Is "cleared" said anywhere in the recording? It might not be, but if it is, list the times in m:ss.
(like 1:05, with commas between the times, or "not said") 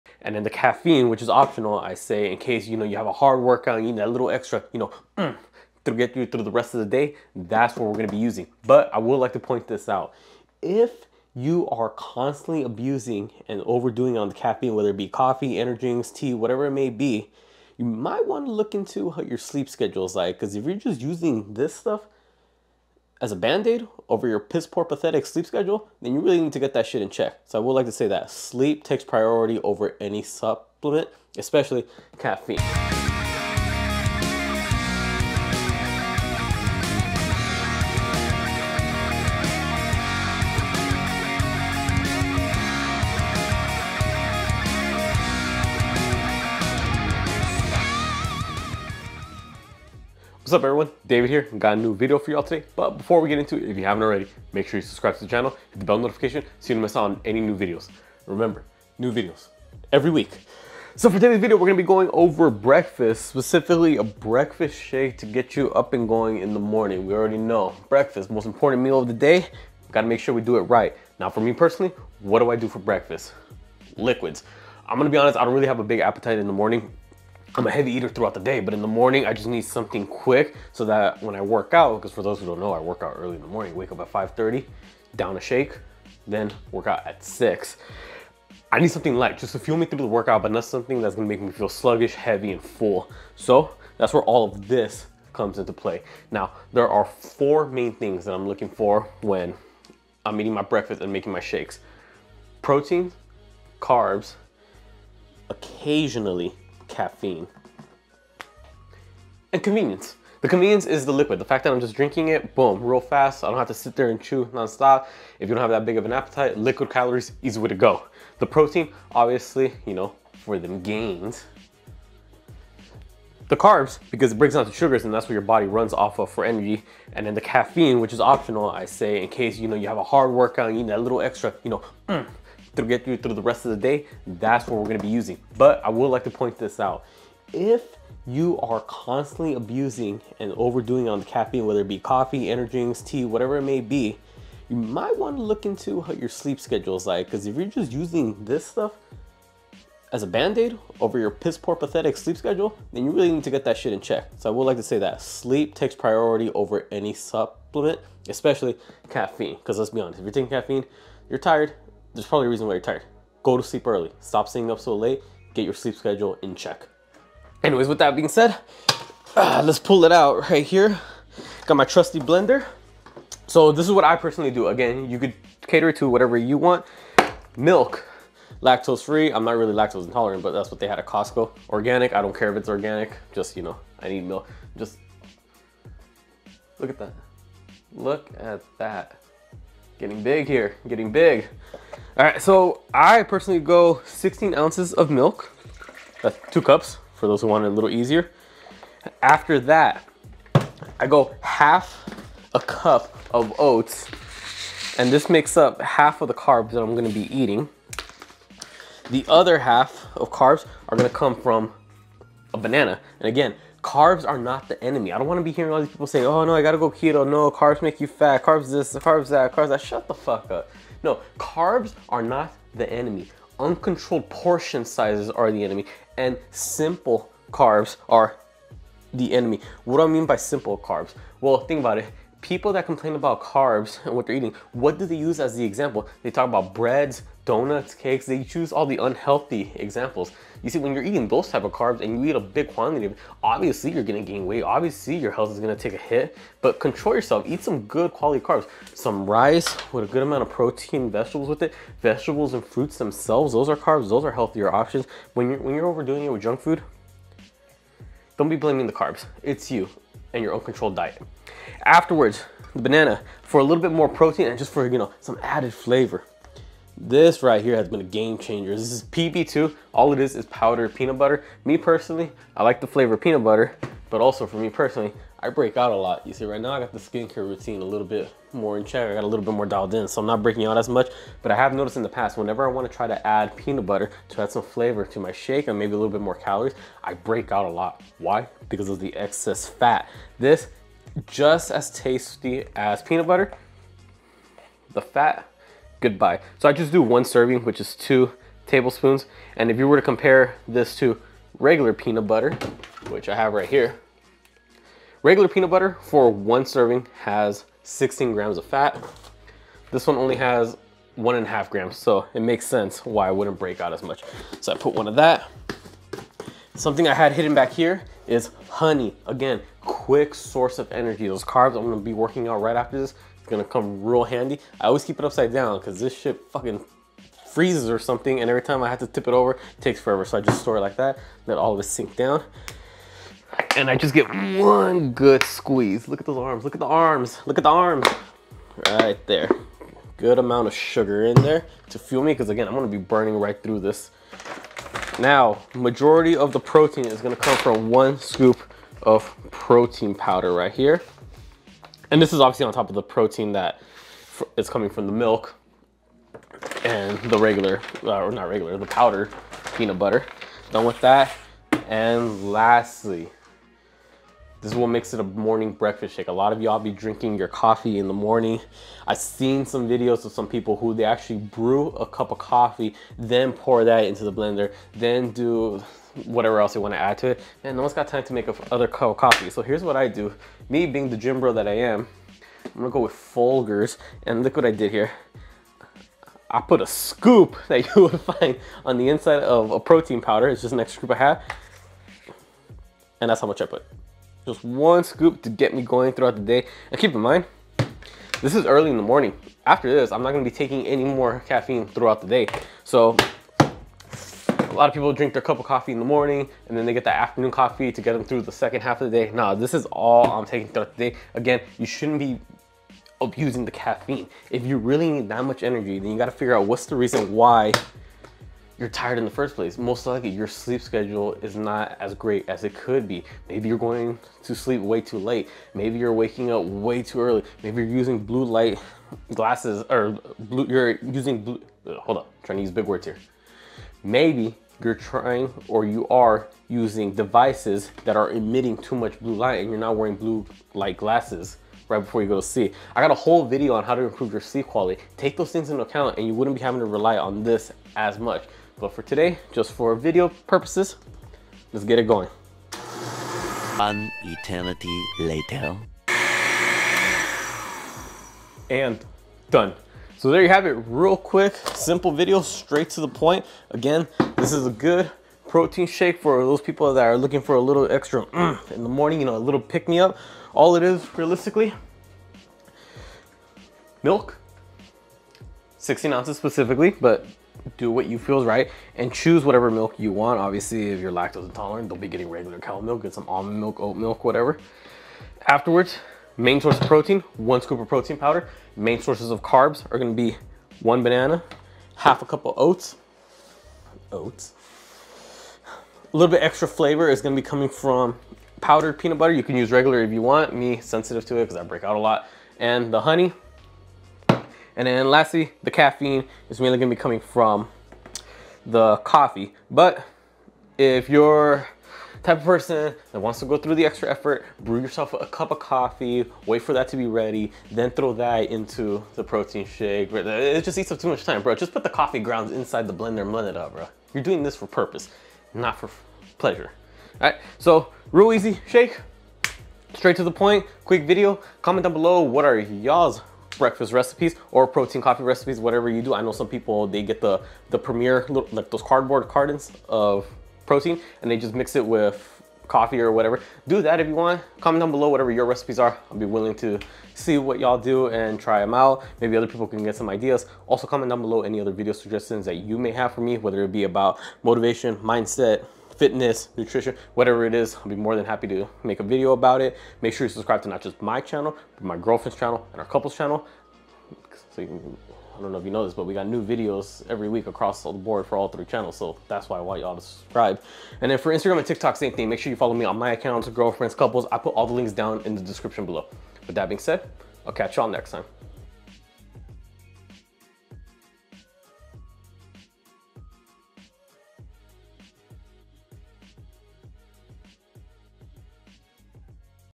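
not said.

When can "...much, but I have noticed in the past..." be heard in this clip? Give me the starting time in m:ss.
4:40.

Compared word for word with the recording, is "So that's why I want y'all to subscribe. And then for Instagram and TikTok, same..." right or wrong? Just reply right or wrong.
right.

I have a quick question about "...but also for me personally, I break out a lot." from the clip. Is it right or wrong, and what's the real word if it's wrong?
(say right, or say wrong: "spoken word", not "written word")
right.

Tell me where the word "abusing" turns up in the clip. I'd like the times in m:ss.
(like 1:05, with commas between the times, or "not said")
0:12, 2:19, 6:53.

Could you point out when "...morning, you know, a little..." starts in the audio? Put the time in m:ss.
7:48.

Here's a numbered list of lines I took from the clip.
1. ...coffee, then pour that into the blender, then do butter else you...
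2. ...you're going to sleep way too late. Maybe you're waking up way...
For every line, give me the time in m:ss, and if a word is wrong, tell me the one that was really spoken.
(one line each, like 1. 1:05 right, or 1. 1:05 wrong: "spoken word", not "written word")
1. 6:12 wrong: "whatever", not "butter"
2. 7:03 right.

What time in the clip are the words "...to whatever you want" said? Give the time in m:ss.
2:55.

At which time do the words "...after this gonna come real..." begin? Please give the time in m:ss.
5:22.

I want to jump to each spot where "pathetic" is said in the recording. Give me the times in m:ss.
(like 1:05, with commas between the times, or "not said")
0:24, 2:31.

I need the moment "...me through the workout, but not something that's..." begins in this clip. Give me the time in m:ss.
1:29.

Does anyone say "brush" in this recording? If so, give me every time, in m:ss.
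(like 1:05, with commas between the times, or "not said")
not said.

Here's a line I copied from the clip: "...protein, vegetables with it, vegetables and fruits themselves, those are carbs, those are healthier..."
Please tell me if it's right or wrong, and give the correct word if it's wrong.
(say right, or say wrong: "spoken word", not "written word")
right.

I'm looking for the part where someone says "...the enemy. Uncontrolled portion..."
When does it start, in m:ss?
3:42.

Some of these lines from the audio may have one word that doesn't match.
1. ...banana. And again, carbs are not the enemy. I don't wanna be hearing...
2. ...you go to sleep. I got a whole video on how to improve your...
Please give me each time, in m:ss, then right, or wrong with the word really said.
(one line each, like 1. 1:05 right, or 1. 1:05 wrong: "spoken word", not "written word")
1. 3:32 right
2. 7:22 right.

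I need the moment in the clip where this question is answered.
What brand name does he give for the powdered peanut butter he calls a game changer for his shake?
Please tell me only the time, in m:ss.
4:29.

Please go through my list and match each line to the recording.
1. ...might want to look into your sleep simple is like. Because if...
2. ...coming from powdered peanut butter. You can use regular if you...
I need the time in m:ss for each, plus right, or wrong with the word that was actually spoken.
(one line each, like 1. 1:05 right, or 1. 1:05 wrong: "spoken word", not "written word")
1. 0:17 wrong: "schedule", not "simple"
2. 8:17 right.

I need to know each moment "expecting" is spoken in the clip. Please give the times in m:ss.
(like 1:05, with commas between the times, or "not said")
not said.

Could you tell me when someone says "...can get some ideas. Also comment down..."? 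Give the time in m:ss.
9:09.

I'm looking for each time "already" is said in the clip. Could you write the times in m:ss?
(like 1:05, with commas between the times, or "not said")
0:54, 1:07.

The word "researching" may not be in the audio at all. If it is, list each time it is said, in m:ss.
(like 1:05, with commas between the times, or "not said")
not said.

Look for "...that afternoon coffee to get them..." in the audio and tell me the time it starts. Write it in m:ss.
6:47.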